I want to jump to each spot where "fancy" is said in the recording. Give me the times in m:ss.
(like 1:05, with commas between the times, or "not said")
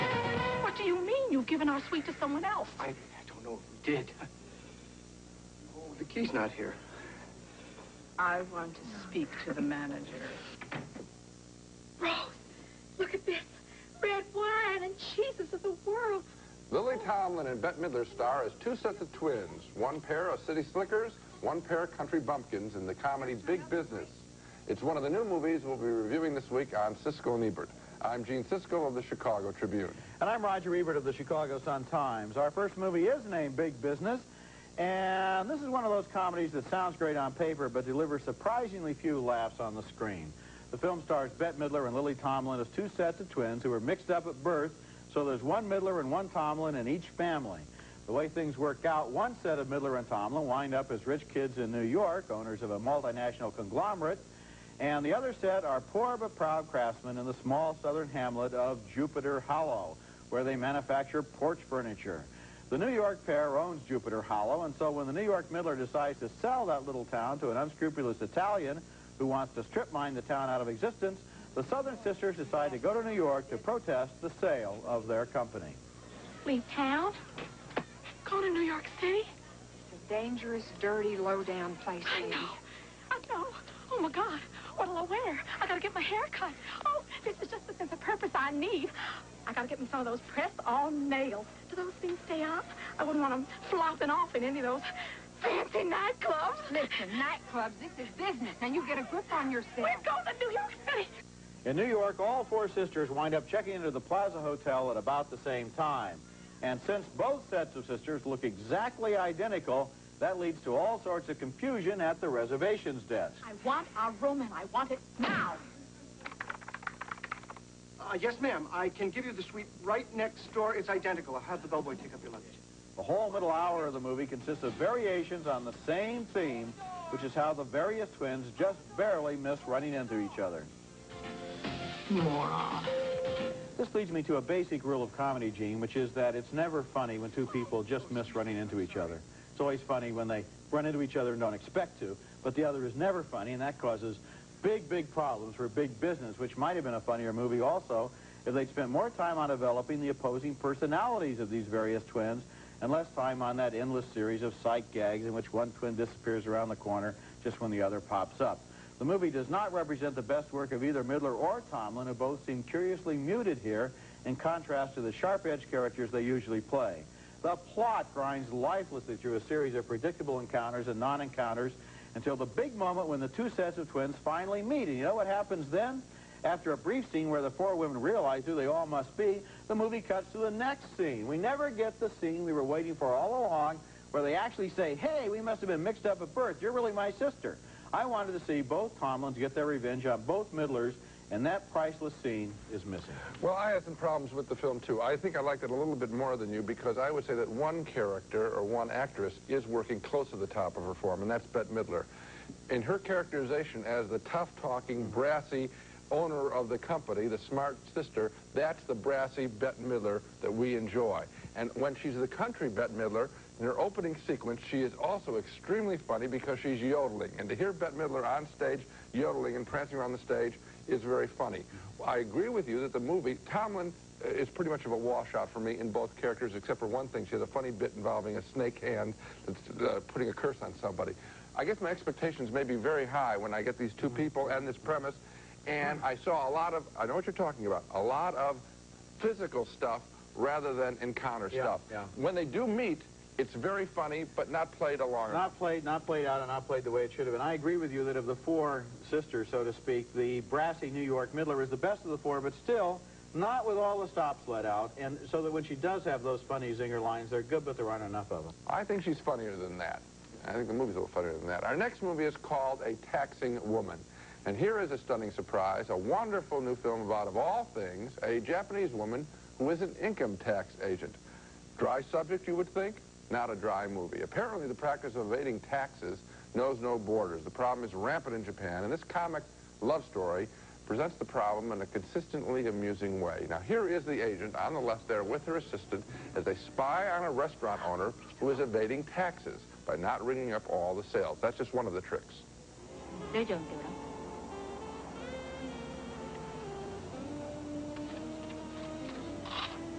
1:35.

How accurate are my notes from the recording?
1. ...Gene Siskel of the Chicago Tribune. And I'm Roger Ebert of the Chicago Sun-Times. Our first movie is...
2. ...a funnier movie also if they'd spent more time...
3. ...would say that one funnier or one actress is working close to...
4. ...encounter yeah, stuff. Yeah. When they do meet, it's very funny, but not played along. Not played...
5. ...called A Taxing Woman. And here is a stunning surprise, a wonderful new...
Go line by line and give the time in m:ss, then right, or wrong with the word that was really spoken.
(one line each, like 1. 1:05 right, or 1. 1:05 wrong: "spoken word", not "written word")
1. 0:28 right
2. 2:26 right
3. 3:17 wrong: "character", not "funnier"
4. 4:01 right
5. 4:22 right.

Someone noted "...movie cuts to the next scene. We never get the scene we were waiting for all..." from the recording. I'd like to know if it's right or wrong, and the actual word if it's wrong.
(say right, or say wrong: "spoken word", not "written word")
right.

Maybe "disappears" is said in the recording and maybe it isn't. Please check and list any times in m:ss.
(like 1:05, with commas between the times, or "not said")
2:35.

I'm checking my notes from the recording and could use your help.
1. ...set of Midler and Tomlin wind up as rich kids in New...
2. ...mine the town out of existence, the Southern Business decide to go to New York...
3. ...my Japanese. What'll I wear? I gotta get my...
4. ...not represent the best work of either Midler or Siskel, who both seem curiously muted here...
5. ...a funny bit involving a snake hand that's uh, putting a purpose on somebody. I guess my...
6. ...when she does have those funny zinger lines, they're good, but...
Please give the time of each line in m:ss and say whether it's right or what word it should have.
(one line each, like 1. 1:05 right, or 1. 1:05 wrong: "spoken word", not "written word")
1. 0:49 right
2. 1:09 wrong: "Sisters", not "Business"
3. 1:24 wrong: "God", not "Japanese"
4. 2:39 wrong: "Tomlin", not "Siskel"
5. 3:47 wrong: "curse", not "purpose"
6. 4:15 right.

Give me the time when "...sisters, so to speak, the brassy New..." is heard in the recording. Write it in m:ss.
4:09.